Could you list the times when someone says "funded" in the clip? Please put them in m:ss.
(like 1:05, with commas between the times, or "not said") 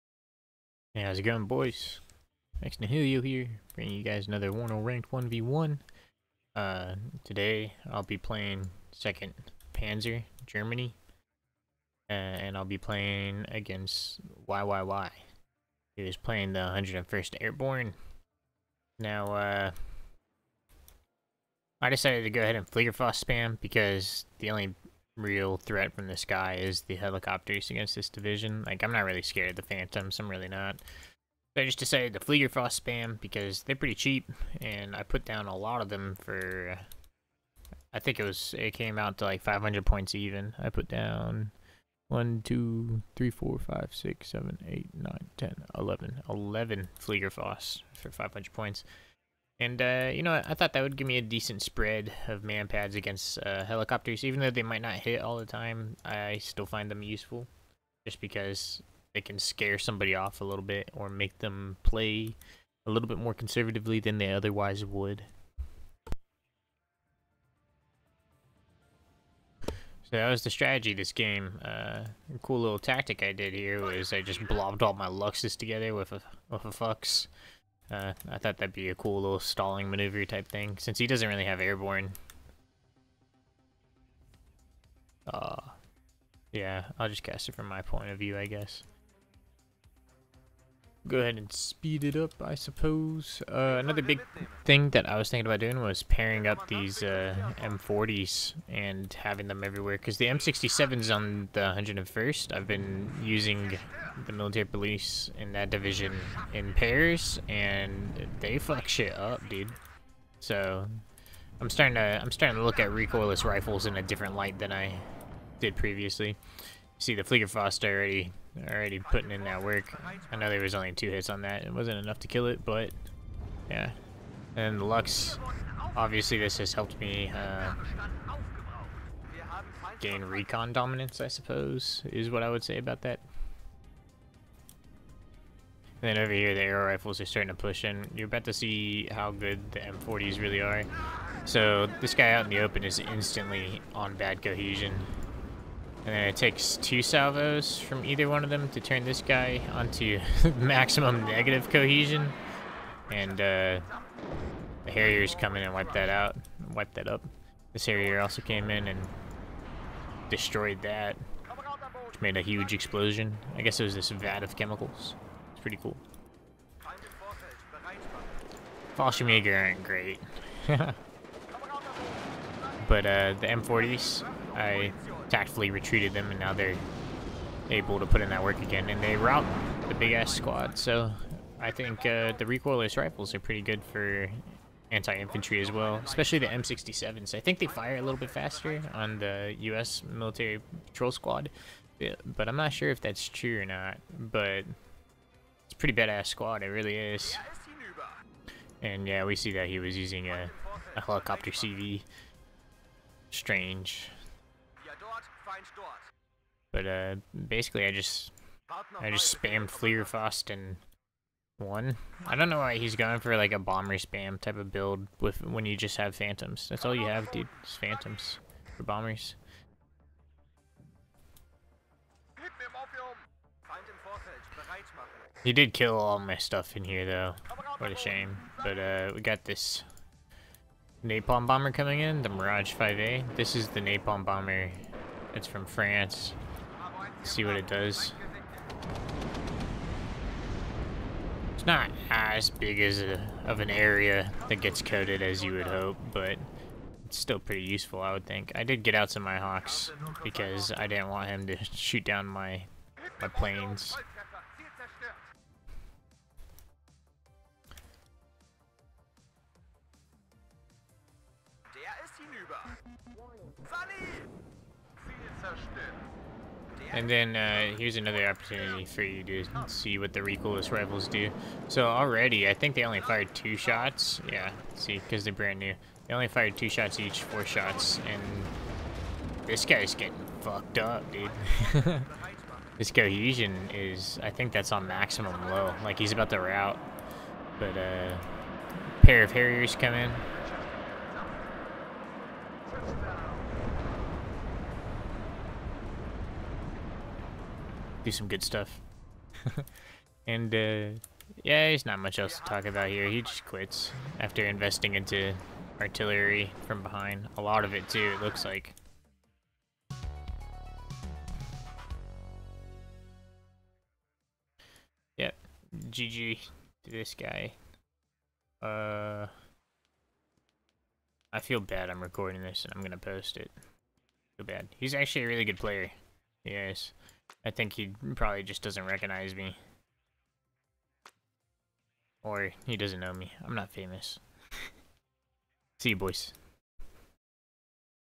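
not said.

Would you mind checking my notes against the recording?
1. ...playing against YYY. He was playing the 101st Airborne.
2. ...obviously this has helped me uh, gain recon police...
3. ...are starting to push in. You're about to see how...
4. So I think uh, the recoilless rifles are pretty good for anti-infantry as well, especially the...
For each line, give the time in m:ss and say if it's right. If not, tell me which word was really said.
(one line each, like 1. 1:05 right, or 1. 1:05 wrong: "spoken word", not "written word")
1. 0:12 right
2. 2:05 wrong: "dominance", not "police"
3. 2:17 right
4. 3:00 right.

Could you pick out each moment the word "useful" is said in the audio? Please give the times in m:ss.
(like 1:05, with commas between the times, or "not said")
0:57, 4:07.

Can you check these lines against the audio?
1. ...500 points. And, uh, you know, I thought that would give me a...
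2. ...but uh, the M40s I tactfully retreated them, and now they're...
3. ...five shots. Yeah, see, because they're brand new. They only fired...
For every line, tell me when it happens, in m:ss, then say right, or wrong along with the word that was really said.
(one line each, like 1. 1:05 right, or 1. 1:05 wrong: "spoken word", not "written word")
1. 0:48 right
2. 2:52 right
3. 4:33 wrong: "two", not "five".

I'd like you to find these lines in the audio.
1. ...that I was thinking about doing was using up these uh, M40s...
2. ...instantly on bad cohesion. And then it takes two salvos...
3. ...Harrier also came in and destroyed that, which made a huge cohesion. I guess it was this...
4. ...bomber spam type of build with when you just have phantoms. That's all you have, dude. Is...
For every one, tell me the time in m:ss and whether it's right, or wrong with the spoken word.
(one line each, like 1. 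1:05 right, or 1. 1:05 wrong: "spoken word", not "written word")
1. 1:34 wrong: "pairing", not "using"
2. 2:22 right
3. 2:37 wrong: "explosion", not "cohesion"
4. 3:33 right.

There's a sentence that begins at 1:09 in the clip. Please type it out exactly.
So that was the strategy this game.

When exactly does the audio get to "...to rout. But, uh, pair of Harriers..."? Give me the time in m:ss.
4:46.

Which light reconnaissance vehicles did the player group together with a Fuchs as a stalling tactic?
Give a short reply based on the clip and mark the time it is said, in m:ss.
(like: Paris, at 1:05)
Luchses, at 1:15.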